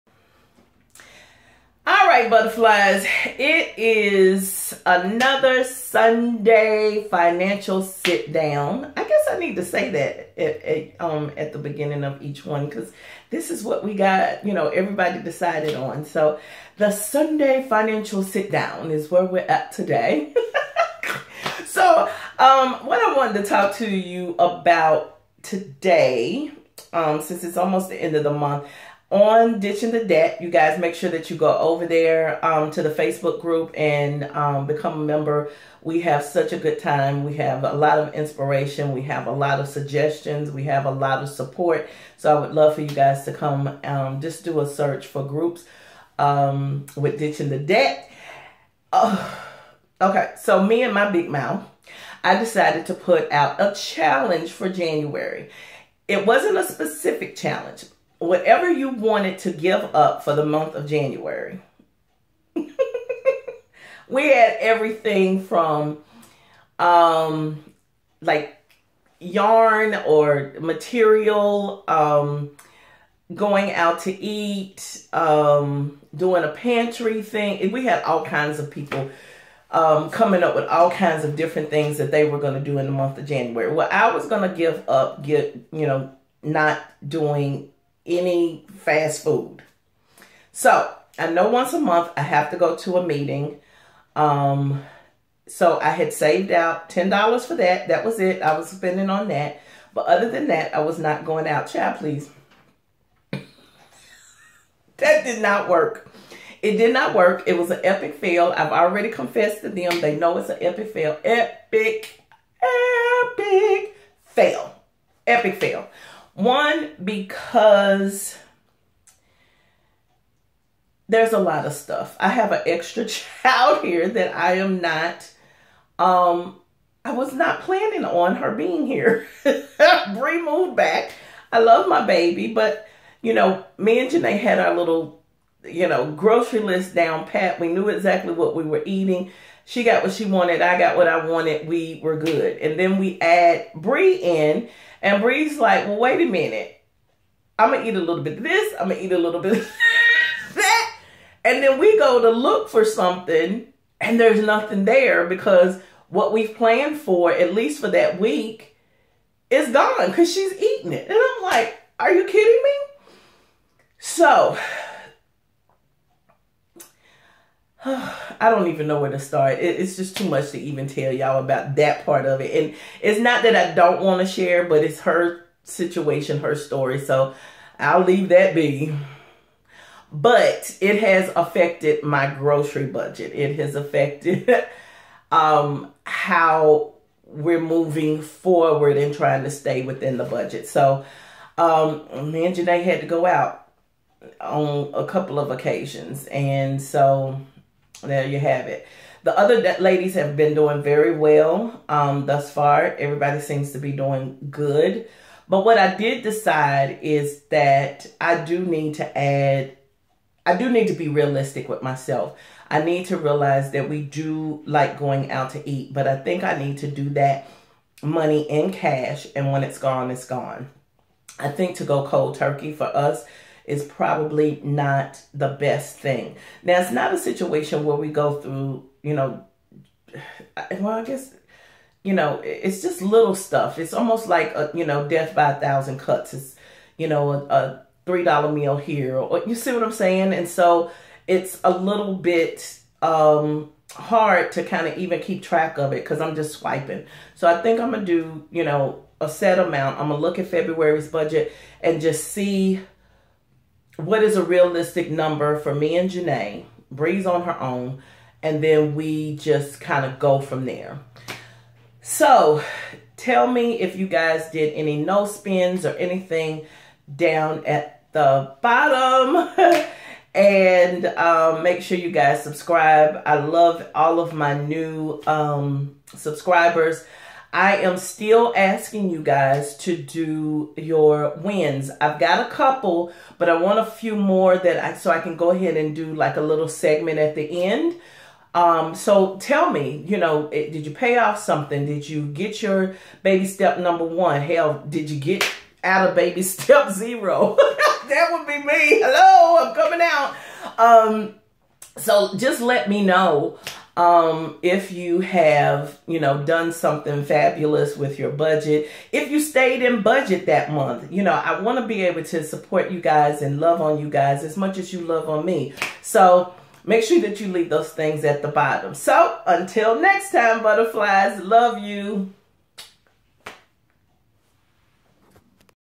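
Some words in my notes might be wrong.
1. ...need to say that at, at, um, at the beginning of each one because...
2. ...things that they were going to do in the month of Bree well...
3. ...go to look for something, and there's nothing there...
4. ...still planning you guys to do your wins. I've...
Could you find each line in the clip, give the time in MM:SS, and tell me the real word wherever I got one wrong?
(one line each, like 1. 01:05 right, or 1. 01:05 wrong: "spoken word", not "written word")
1. 00:09 right
2. 01:21 wrong: "January", not "Bree"
3. 02:31 right
4. 04:37 wrong: "asking", not "planning".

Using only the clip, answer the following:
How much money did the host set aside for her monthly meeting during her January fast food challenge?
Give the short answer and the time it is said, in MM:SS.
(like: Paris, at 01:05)
$10, at 01:36.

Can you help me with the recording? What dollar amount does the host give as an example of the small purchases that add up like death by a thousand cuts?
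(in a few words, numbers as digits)
$3.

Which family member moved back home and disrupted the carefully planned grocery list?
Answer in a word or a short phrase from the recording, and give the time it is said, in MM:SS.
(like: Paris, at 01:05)
Brie, at 02:10.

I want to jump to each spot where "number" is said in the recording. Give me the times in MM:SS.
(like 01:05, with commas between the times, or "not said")
04:15, 04:53.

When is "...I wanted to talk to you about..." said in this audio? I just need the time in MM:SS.
00:23.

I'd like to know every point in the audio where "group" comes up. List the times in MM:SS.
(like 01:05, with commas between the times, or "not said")
00:33, 00:45.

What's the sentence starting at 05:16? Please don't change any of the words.
So make sure that you leave those things at the bottom.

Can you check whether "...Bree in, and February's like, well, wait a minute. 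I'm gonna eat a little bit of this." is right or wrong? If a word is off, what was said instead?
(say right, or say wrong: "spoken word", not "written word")
wrong: "Bree", not "February".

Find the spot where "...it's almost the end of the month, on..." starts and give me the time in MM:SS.
00:27.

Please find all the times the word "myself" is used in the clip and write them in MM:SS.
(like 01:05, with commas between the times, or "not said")
03:31.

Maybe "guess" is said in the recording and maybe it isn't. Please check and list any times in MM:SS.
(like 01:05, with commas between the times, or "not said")
00:09, 03:51.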